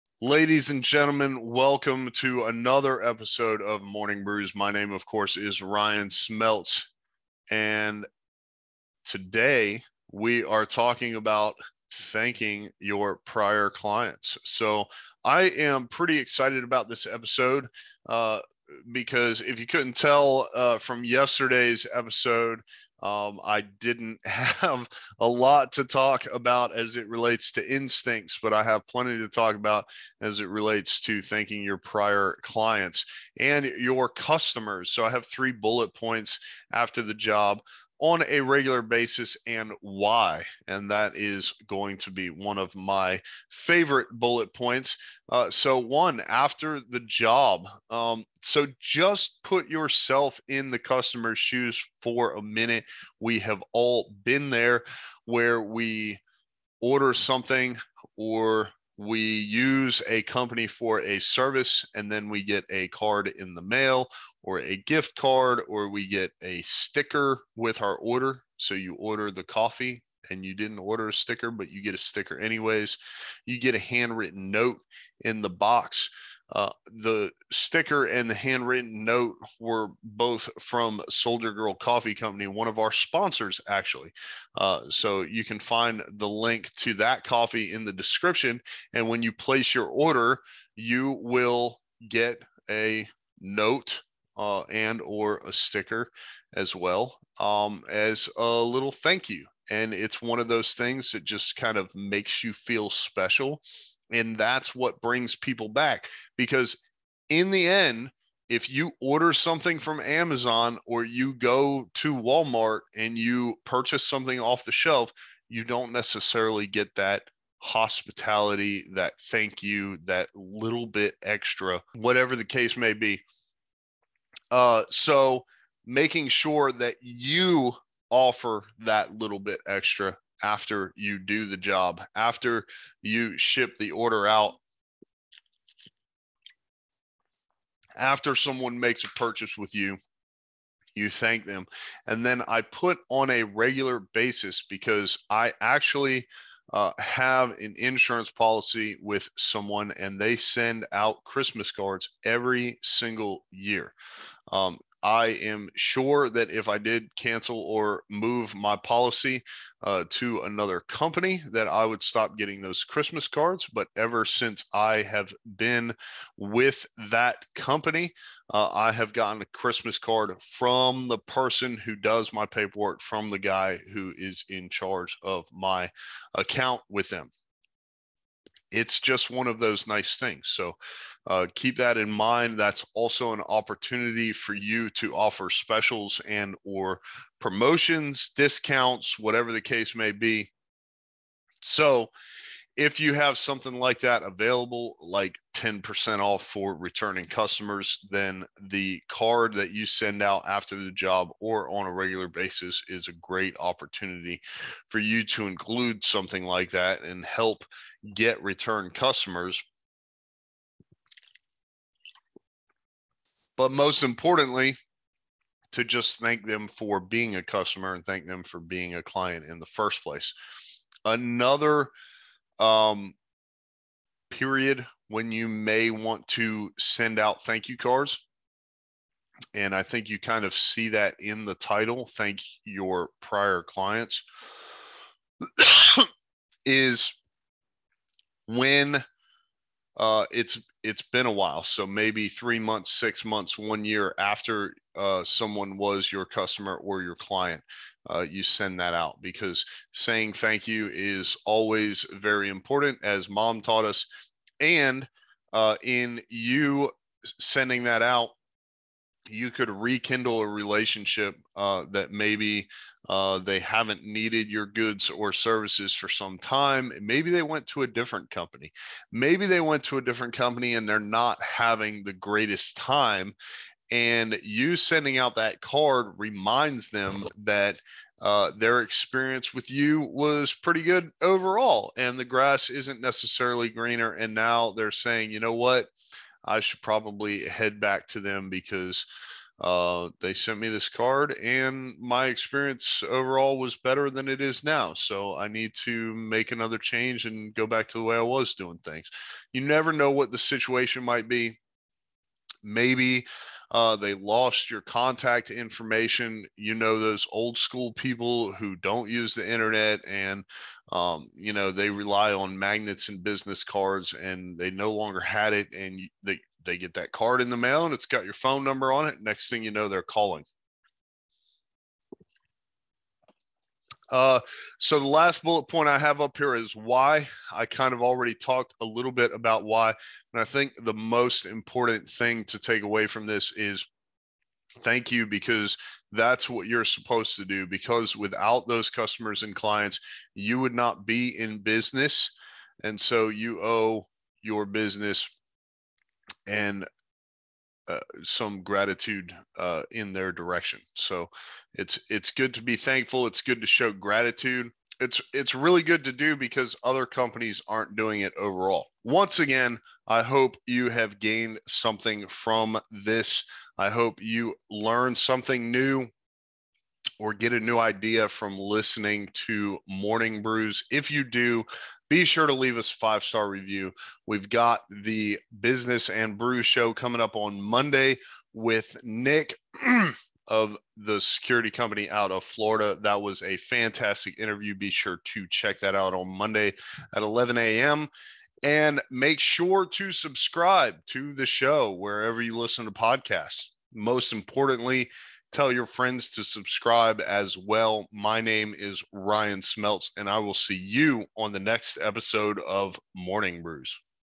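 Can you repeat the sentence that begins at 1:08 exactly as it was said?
So you order the coffee and you didn't order a sticker, but you get a sticker anyways.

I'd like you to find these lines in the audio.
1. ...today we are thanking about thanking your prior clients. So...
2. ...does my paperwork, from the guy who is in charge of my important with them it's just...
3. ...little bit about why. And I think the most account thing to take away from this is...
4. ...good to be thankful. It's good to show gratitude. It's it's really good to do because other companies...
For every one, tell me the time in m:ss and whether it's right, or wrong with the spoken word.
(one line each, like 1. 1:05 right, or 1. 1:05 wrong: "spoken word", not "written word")
1. 0:09 wrong: "talking", not "thanking"
2. 2:51 wrong: "account", not "important"
3. 5:28 wrong: "important", not "account"
4. 5:52 right.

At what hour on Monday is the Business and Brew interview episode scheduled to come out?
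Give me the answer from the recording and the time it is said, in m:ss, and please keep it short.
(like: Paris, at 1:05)
11 a.m., at 6:27.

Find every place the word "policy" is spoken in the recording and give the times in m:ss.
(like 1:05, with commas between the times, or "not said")
2:28, 2:38.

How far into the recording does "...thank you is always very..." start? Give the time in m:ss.
4:10.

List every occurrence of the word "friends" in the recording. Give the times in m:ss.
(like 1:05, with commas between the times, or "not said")
6:35.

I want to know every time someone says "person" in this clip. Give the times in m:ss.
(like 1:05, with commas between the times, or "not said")
2:51.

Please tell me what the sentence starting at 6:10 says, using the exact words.
If you do, be sure to leave us five star review.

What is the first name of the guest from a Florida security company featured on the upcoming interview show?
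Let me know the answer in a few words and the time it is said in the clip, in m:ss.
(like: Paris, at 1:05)
Nick, at 6:19.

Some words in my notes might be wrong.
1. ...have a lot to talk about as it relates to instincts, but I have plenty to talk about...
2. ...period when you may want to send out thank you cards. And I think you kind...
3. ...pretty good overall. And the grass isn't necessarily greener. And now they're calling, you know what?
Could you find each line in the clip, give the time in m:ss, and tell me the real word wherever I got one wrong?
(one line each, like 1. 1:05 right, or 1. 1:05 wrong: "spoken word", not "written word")
1. 0:24 right
2. 3:44 right
3. 4:40 wrong: "saying", not "calling".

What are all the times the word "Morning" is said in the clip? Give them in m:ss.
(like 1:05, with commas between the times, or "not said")
0:03, 6:09, 6:43.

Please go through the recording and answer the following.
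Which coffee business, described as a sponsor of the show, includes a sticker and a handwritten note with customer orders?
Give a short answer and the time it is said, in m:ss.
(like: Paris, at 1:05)
Soldier Girl Coffee Company, at 1:21.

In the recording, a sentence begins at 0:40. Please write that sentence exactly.
And that is going to be one of my favorite bullet points.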